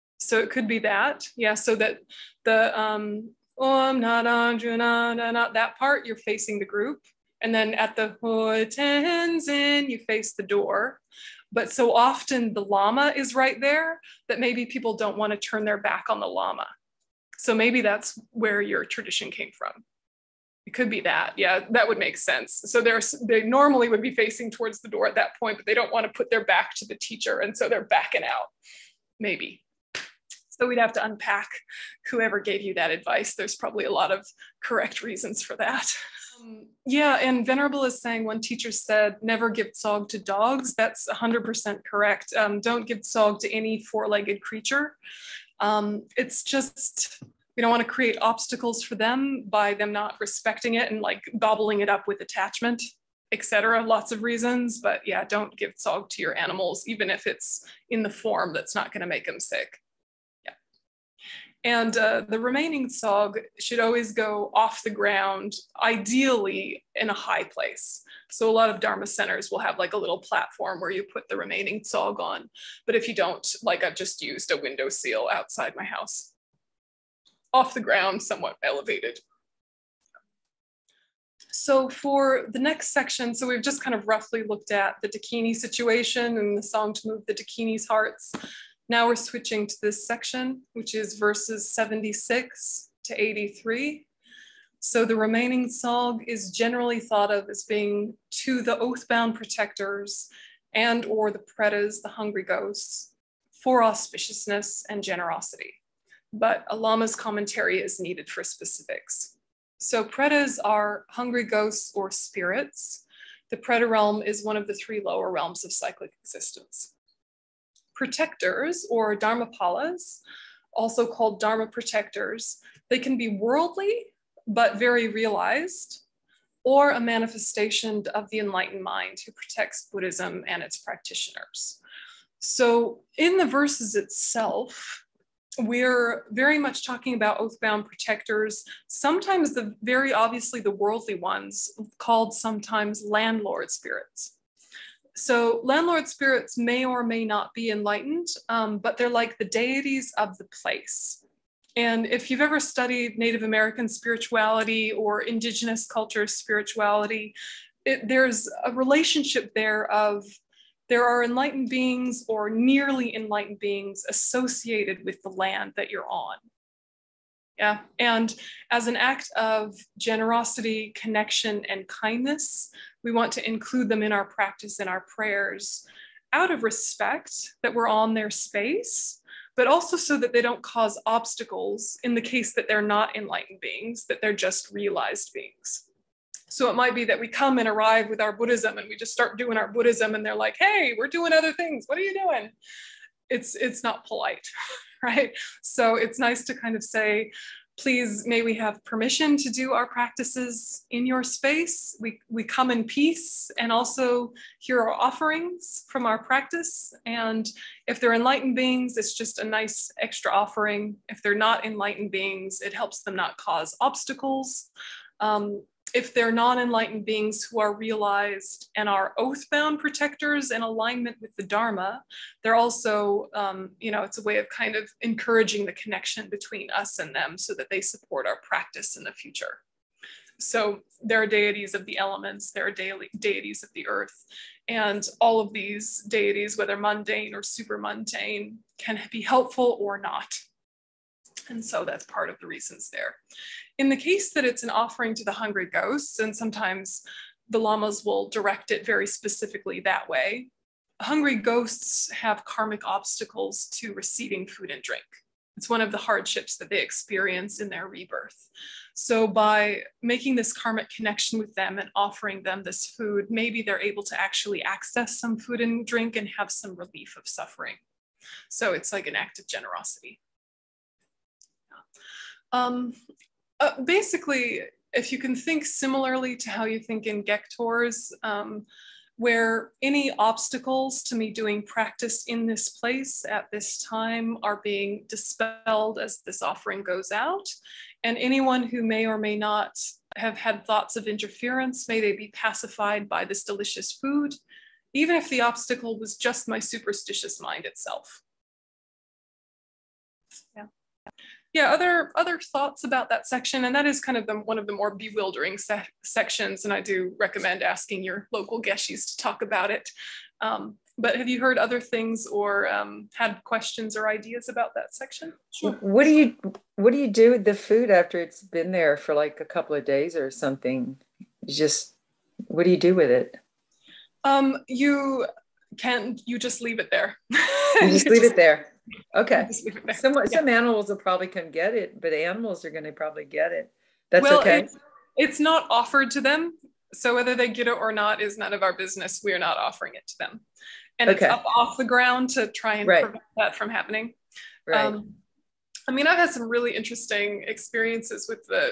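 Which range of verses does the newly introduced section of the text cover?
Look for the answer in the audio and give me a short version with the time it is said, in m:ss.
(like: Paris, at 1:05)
76 to 83, at 1:31.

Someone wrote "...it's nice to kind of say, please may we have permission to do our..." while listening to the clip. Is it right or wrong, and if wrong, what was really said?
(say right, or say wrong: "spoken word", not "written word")
right.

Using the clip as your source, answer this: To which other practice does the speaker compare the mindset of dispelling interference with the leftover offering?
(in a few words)
gektors.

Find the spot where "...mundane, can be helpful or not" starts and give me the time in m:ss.
3:57.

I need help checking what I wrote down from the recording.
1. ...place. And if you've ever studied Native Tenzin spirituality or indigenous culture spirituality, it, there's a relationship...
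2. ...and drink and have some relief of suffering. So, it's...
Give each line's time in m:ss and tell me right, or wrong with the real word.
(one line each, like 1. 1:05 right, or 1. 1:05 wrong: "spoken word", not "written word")
1. 2:30 wrong: "American", not "Tenzin"
2. 4:25 right.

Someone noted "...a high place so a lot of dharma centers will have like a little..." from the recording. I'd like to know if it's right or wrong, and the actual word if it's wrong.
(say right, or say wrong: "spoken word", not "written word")
right.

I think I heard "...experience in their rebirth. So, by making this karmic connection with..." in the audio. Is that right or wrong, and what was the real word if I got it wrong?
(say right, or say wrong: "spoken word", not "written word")
right.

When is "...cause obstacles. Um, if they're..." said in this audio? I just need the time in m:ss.
3:33.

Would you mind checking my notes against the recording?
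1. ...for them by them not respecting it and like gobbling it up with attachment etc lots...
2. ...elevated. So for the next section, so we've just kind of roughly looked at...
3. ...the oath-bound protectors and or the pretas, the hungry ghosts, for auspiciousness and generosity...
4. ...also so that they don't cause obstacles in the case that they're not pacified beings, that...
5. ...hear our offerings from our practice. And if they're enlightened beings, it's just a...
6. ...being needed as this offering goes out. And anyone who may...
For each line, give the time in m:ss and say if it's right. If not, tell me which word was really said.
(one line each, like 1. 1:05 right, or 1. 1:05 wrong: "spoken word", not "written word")
1. 0:48 right
2. 1:18 right
3. 1:38 right
4. 2:59 wrong: "enlightened", not "pacified"
5. 3:24 right
6. 4:44 wrong: "dispelled", not "needed".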